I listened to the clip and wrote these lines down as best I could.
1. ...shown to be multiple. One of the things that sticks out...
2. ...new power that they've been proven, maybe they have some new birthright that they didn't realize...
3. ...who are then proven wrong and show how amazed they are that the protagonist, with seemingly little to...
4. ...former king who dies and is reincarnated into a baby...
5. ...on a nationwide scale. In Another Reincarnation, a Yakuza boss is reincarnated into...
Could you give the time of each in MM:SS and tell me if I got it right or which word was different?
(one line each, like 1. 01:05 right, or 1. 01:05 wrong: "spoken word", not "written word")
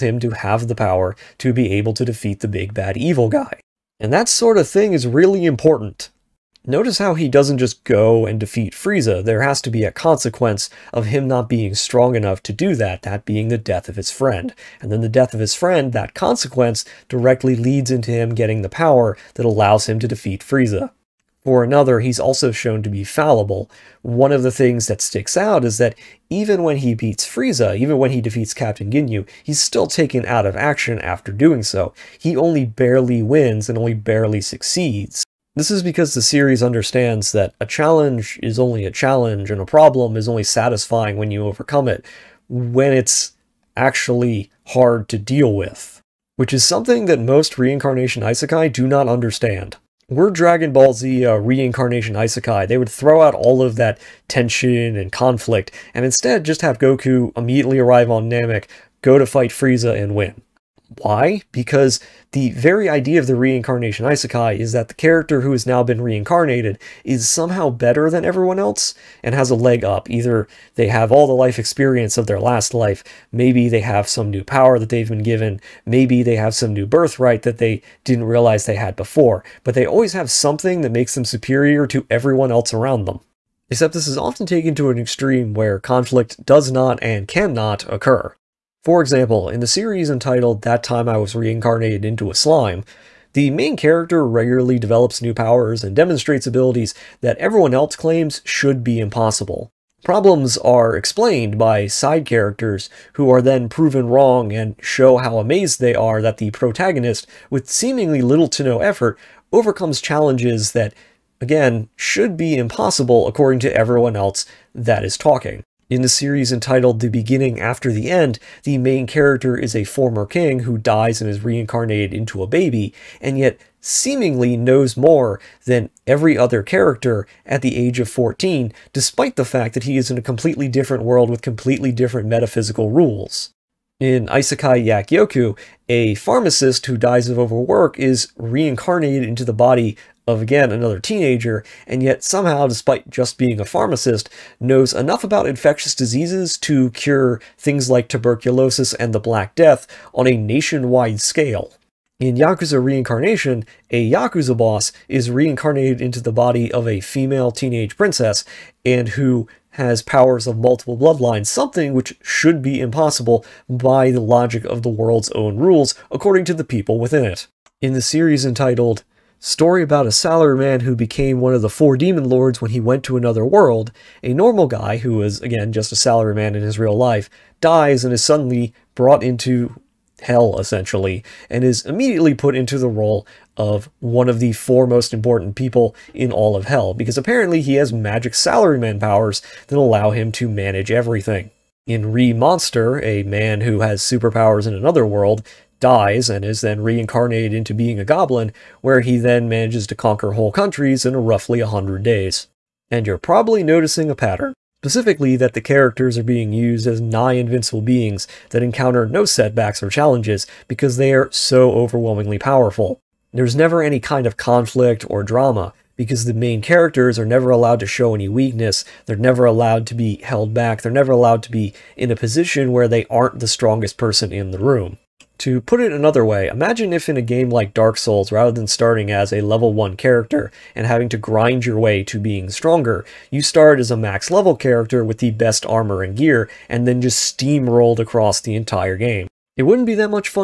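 1. 00:22 wrong: "fallible", not "multiple"
2. 01:14 wrong: "given", not "proven"
3. 01:43 right
4. 01:59 right
5. 02:30 wrong: "Yakuza", not "Another".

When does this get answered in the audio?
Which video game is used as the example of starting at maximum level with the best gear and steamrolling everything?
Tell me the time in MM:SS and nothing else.
03:47.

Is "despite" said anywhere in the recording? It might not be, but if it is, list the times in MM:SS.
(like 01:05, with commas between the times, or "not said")
02:08, 02:22.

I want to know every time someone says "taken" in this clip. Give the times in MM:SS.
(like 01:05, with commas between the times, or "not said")
00:29, 01:24.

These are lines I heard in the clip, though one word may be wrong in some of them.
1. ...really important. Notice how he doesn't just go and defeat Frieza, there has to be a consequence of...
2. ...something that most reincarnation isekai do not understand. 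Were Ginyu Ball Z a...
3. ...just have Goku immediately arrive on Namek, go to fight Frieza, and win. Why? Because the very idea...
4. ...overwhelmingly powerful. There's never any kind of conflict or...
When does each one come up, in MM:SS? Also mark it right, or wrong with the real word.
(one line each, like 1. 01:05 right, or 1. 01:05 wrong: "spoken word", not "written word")
1. 00:05 right
2. 00:46 wrong: "Dragon", not "Ginyu"
3. 00:56 right
4. 03:31 right.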